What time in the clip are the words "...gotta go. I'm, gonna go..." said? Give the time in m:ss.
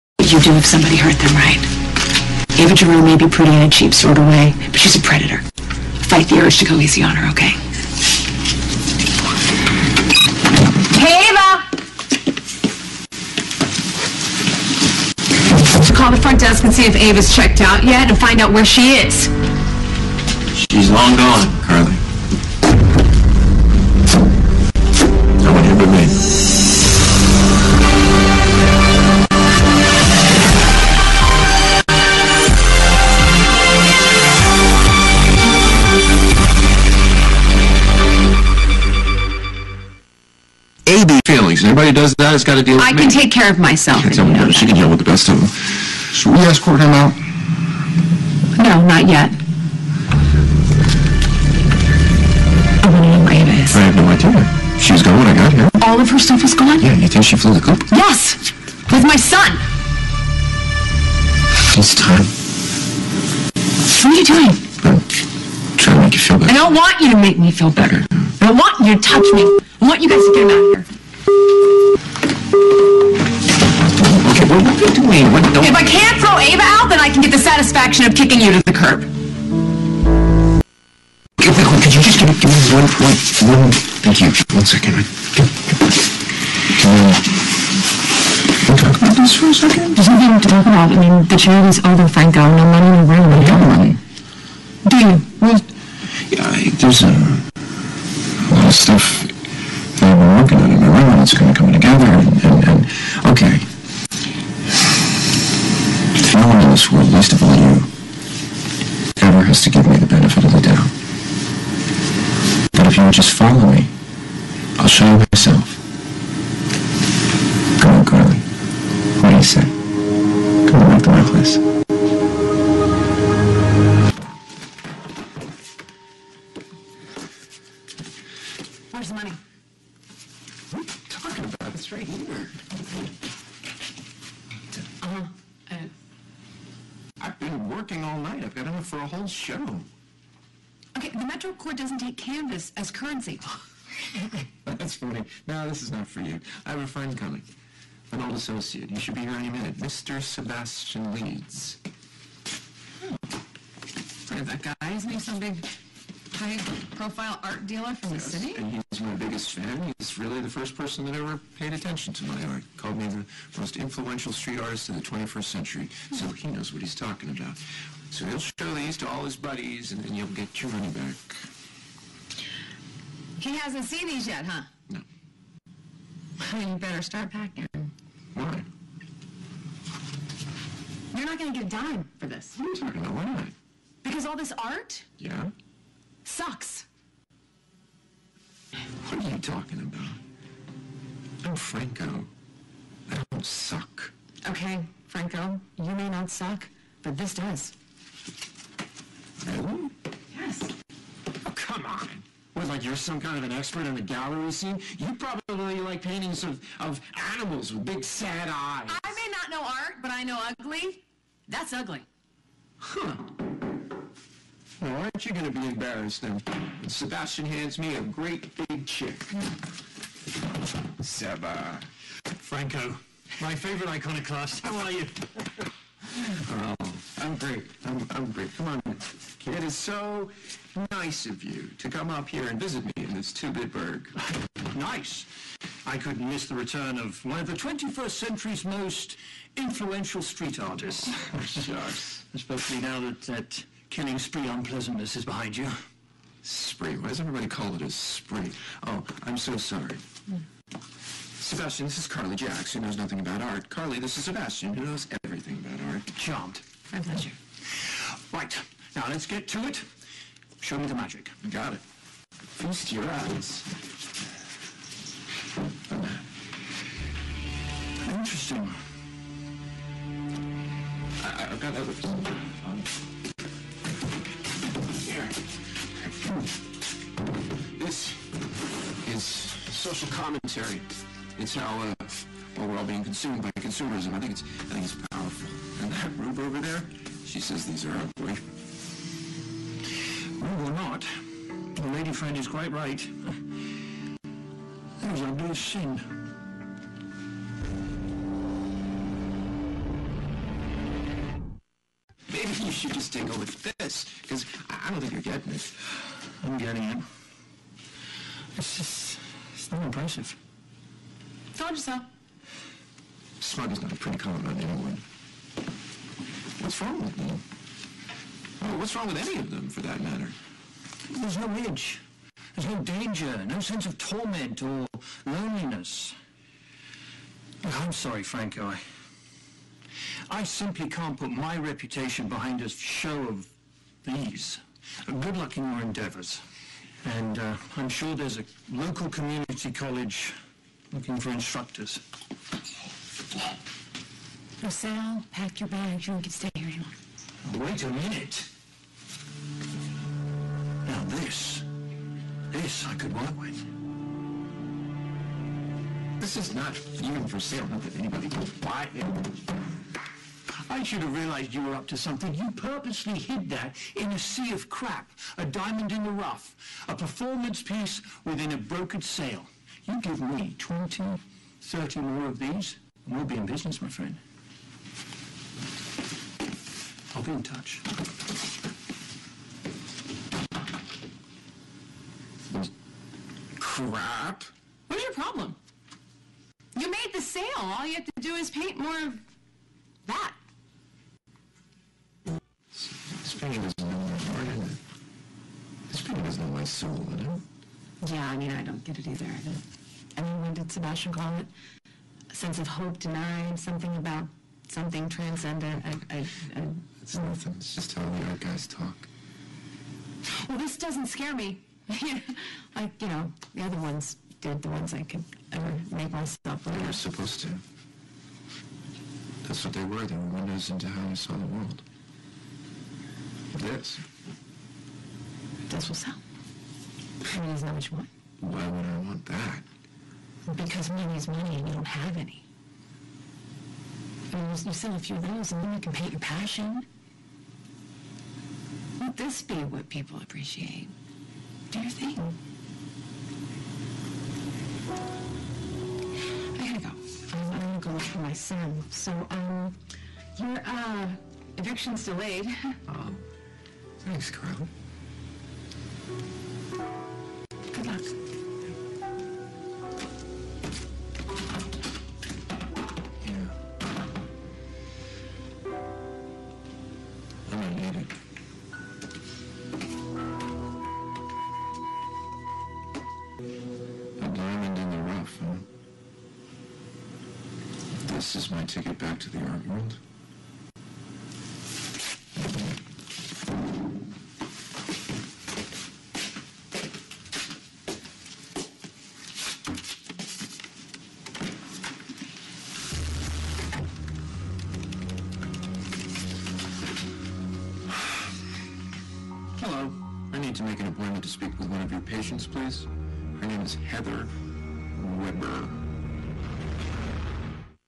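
7:26.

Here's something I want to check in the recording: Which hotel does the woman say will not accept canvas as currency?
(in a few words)
Metro Court.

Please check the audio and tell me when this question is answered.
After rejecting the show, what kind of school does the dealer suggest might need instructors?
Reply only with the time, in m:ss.
5:39.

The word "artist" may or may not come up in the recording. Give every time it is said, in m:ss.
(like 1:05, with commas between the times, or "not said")
2:44, 4:00.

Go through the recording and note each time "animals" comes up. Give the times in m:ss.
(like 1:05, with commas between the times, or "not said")
3:27.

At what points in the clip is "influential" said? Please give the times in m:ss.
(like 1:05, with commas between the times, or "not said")
2:43, 3:59.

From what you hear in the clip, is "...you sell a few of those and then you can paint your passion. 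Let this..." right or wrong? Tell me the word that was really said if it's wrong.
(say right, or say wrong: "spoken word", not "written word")
right.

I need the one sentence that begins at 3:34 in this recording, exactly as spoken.
Now, aren't you going to be embarrassed now?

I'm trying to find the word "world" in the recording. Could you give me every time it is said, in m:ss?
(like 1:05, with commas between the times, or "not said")
7:01, 7:59.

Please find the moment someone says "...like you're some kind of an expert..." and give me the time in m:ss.
3:22.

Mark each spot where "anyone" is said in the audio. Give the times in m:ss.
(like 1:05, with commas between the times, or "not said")
5:14.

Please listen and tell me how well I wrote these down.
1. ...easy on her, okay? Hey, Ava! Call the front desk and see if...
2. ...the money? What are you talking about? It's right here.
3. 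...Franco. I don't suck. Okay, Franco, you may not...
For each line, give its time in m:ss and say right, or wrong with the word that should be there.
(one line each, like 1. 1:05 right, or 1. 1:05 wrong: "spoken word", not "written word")
1. 0:06 right
2. 2:09 right
3. 3:11 right.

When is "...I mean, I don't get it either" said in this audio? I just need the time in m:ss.
6:38.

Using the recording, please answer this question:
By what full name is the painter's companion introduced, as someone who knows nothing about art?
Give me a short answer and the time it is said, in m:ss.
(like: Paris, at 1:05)
Carly Jacks, at 4:12.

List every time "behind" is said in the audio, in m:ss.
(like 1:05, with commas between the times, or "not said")
4:05, 5:32.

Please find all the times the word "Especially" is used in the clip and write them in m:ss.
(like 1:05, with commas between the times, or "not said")
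4:02, 6:33.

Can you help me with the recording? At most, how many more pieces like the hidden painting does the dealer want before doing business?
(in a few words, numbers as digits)
30.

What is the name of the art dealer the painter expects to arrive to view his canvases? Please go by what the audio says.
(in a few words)
Sebastian Leeds.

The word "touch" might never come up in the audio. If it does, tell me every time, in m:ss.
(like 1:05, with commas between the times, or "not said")
1:09, 6:17.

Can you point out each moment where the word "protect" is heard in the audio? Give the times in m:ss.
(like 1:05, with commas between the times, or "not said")
not said.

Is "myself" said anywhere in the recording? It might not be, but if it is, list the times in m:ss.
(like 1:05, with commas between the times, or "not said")
0:43, 1:55, 6:56.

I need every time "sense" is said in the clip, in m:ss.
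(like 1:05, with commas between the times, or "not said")
5:23, 6:42.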